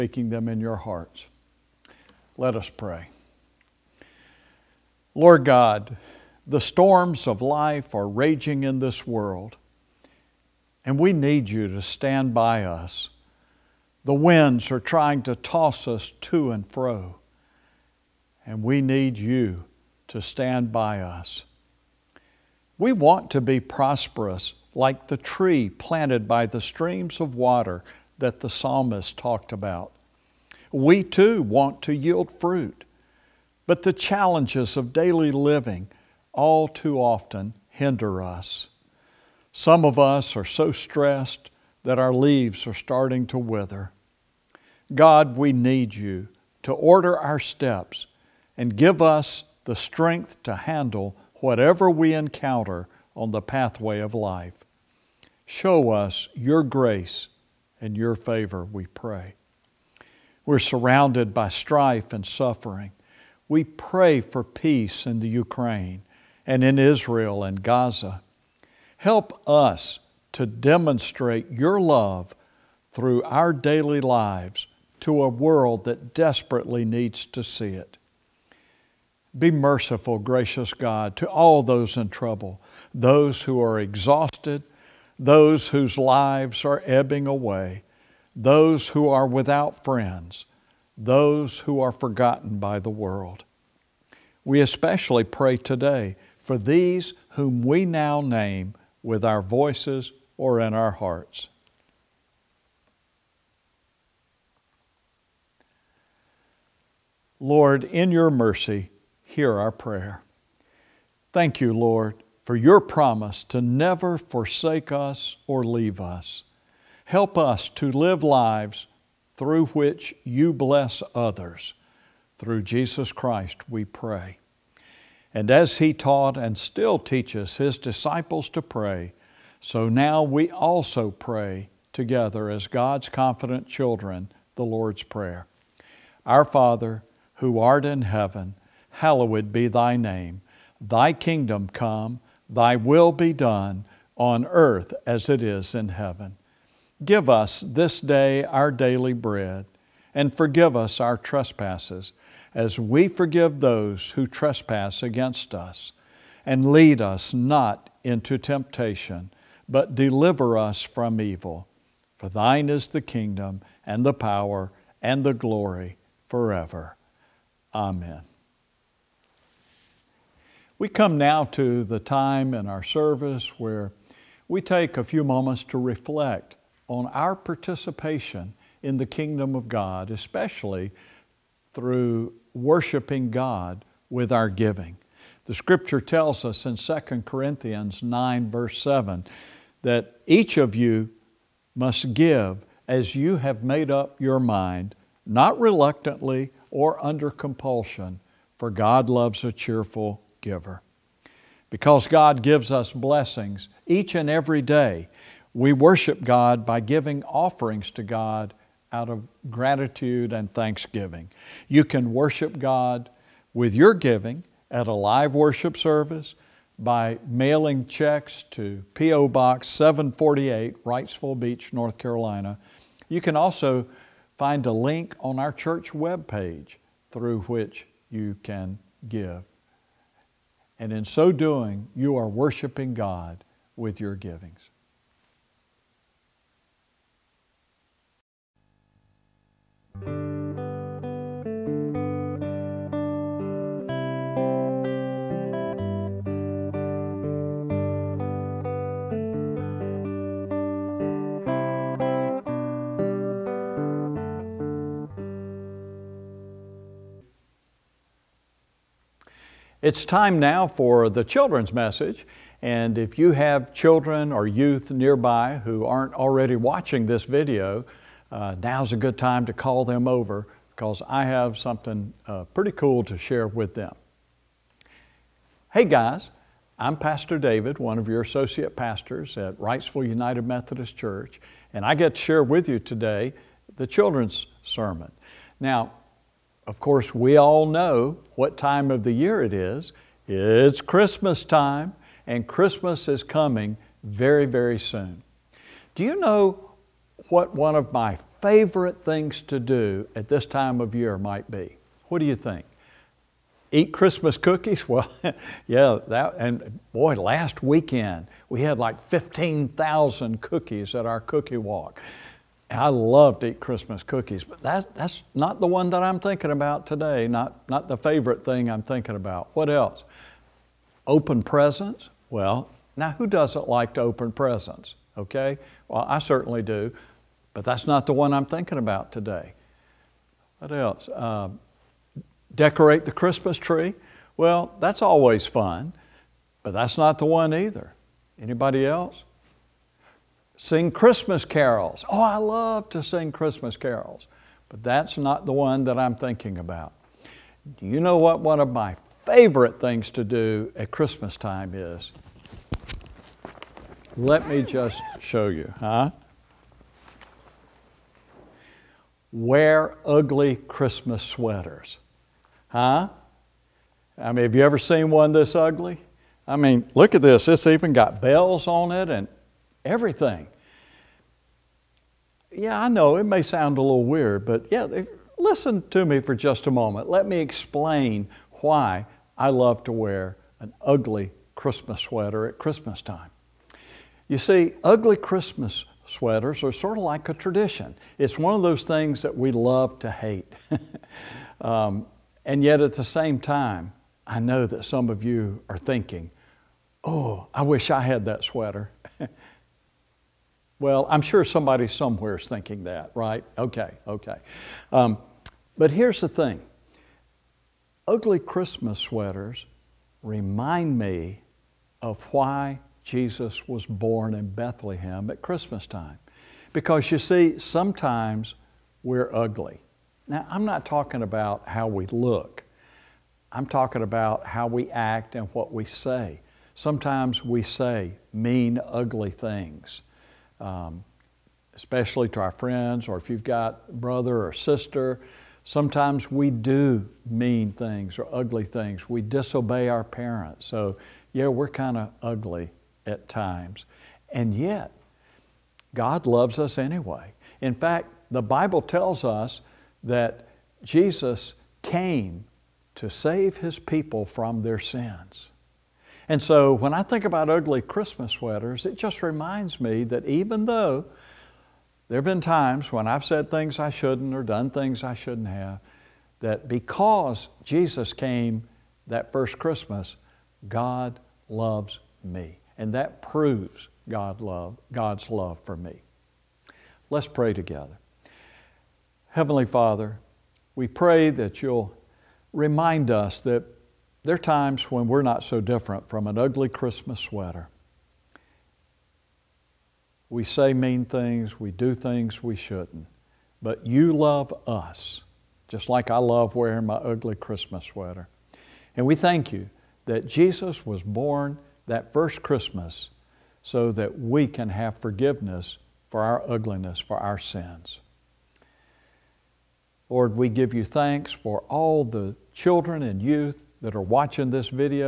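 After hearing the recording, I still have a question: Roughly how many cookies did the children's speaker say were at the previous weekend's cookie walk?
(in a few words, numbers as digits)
15,000.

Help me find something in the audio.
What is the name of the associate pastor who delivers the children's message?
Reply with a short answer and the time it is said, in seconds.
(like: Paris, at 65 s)
David, at 277 s.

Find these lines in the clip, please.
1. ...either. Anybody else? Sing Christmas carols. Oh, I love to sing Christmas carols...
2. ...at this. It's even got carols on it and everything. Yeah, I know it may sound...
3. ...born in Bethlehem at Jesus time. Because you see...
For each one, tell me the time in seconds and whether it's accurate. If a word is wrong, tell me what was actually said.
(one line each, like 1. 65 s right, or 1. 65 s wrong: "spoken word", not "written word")
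1. 337 s right
2. 367 s wrong: "bells", not "carols"
3. 413 s wrong: "Christmas", not "Jesus".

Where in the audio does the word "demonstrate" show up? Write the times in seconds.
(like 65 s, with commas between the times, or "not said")
70 s.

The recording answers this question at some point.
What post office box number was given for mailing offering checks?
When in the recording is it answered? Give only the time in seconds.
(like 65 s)
219 s.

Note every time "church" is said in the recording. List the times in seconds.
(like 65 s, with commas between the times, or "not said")
225 s, 280 s.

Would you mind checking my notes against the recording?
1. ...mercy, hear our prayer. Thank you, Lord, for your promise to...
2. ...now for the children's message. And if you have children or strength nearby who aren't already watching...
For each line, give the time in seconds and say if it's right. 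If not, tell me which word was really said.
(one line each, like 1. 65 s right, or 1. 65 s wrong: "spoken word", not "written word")
1. 108 s right
2. 260 s wrong: "youth", not "strength".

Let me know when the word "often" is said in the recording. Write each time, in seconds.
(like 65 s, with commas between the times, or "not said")
36 s.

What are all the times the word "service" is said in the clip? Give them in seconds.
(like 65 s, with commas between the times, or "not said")
172 s, 215 s.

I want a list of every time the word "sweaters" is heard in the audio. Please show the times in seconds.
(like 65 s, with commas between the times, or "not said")
361 s, 382 s, 386 s, 398 s, 408 s, 458 s, 487 s, 497 s.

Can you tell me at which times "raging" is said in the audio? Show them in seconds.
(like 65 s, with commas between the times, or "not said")
8 s.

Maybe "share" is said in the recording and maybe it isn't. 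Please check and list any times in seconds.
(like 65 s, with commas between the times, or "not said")
273 s, 282 s.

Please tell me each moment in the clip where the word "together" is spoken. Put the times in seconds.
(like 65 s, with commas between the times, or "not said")
131 s, 477 s.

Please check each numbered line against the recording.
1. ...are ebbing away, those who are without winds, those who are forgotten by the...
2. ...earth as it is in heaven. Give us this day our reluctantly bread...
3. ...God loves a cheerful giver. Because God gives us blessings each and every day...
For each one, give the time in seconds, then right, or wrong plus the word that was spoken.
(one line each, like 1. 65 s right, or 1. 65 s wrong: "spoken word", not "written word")
1. 86 s wrong: "friends", not "winds"
2. 144 s wrong: "daily", not "reluctantly"
3. 198 s right.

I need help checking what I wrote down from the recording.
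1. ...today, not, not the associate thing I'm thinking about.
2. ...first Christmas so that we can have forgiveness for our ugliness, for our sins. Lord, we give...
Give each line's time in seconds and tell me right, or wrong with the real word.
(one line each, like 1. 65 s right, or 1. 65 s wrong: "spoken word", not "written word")
1. 316 s wrong: "favorite", not "associate"
2. 502 s right.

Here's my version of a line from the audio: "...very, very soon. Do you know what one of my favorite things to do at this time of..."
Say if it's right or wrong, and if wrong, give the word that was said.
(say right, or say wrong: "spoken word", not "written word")
right.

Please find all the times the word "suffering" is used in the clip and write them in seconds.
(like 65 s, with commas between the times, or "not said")
62 s.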